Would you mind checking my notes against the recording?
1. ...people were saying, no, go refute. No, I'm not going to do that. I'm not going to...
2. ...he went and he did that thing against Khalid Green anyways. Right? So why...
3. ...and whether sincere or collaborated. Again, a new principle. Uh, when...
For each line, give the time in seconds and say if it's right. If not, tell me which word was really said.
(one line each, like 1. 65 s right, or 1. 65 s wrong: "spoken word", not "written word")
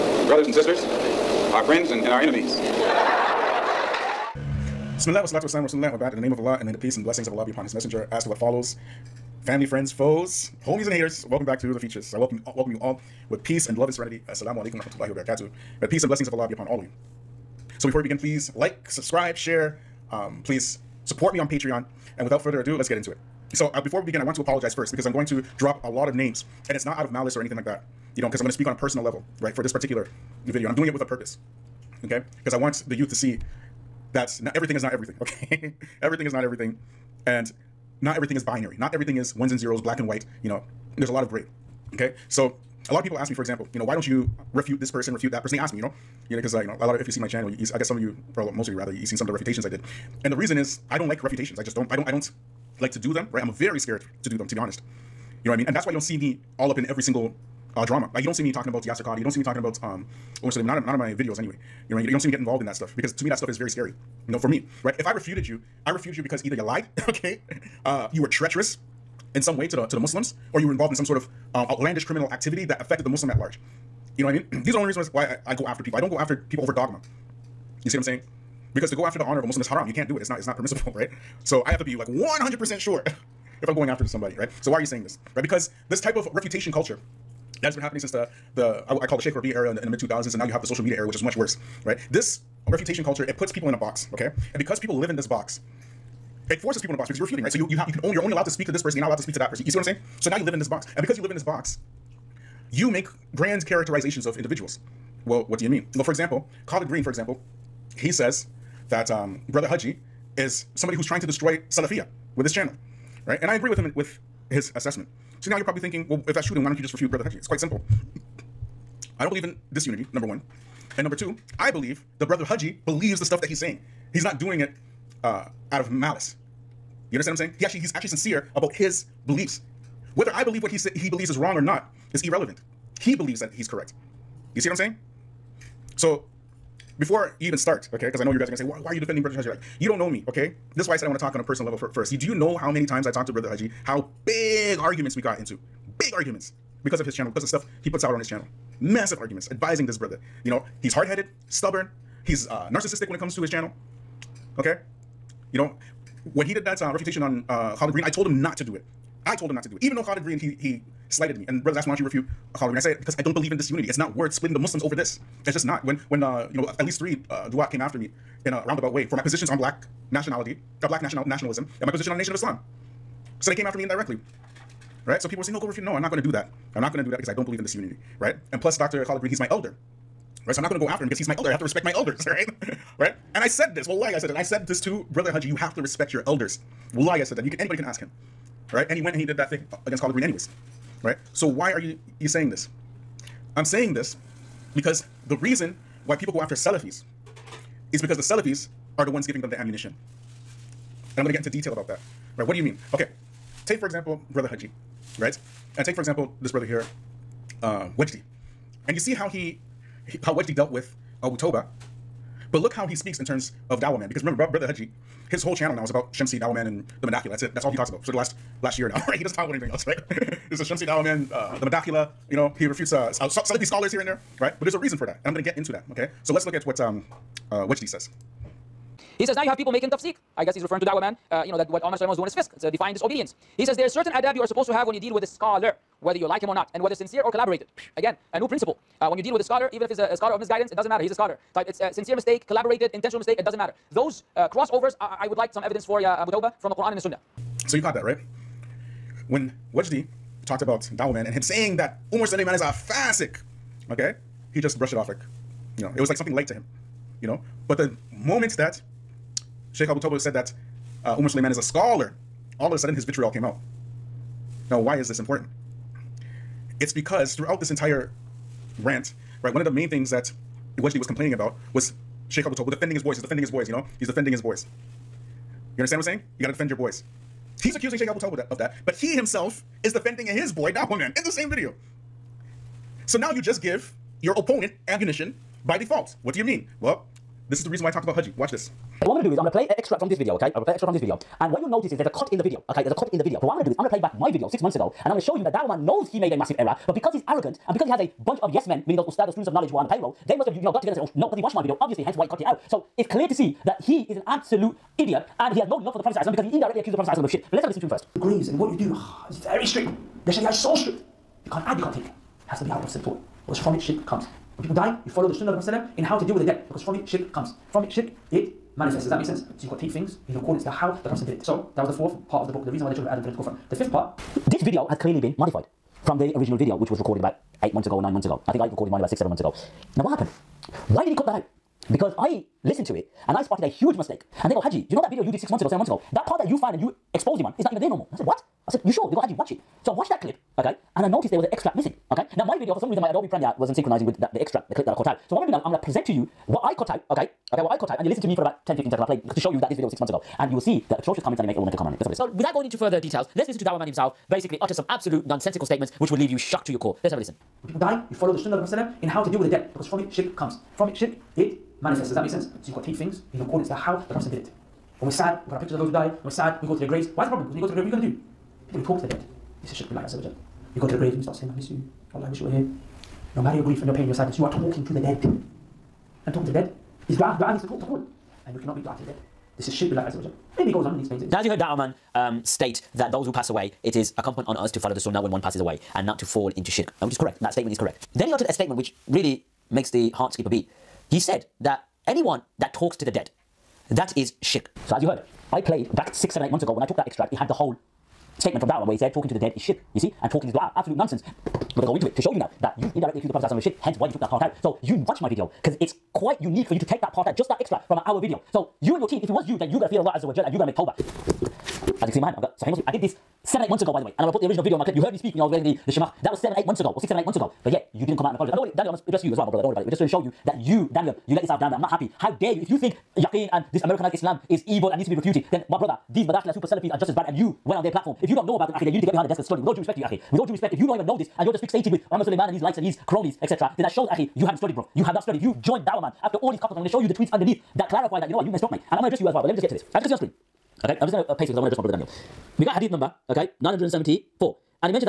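1. 175 s right
2. 188 s right
3. 236 s right.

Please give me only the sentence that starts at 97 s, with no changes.
So you you have you can only you're only allowed to speak to this person.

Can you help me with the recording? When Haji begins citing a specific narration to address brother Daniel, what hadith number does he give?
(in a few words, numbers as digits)
974.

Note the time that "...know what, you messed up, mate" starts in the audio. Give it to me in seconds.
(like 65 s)
438 s.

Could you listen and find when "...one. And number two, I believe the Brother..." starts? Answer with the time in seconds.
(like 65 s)
120 s.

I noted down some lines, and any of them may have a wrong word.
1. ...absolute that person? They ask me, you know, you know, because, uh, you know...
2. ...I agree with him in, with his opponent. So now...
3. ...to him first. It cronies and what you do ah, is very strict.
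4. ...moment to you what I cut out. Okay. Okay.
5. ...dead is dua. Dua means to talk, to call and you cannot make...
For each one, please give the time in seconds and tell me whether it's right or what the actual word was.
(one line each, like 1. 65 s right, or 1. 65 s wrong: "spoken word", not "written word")
1. 45 s wrong: "refute", not "absolute"
2. 113 s wrong: "assessment", not "opponent"
3. 307 s wrong: "grieves", not "cronies"
4. 345 s wrong: "present", not "moment"
5. 376 s right.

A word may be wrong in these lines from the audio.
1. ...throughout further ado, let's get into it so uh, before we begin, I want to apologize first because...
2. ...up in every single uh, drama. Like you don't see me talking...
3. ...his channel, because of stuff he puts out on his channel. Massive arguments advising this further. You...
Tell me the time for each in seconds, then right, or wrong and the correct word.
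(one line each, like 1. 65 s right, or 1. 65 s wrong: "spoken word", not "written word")
1. 22 s wrong: "without", not "throughout"
2. 56 s right
3. 147 s wrong: "brother", not "further".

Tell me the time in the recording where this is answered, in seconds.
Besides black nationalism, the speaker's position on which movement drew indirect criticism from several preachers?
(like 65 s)
172 s.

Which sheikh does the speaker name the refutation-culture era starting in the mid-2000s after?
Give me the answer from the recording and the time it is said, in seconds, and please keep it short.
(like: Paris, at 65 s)
Sheikh Rabi, at 89 s.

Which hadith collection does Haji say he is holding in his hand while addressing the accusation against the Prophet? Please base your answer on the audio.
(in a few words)
Sahih Muslim.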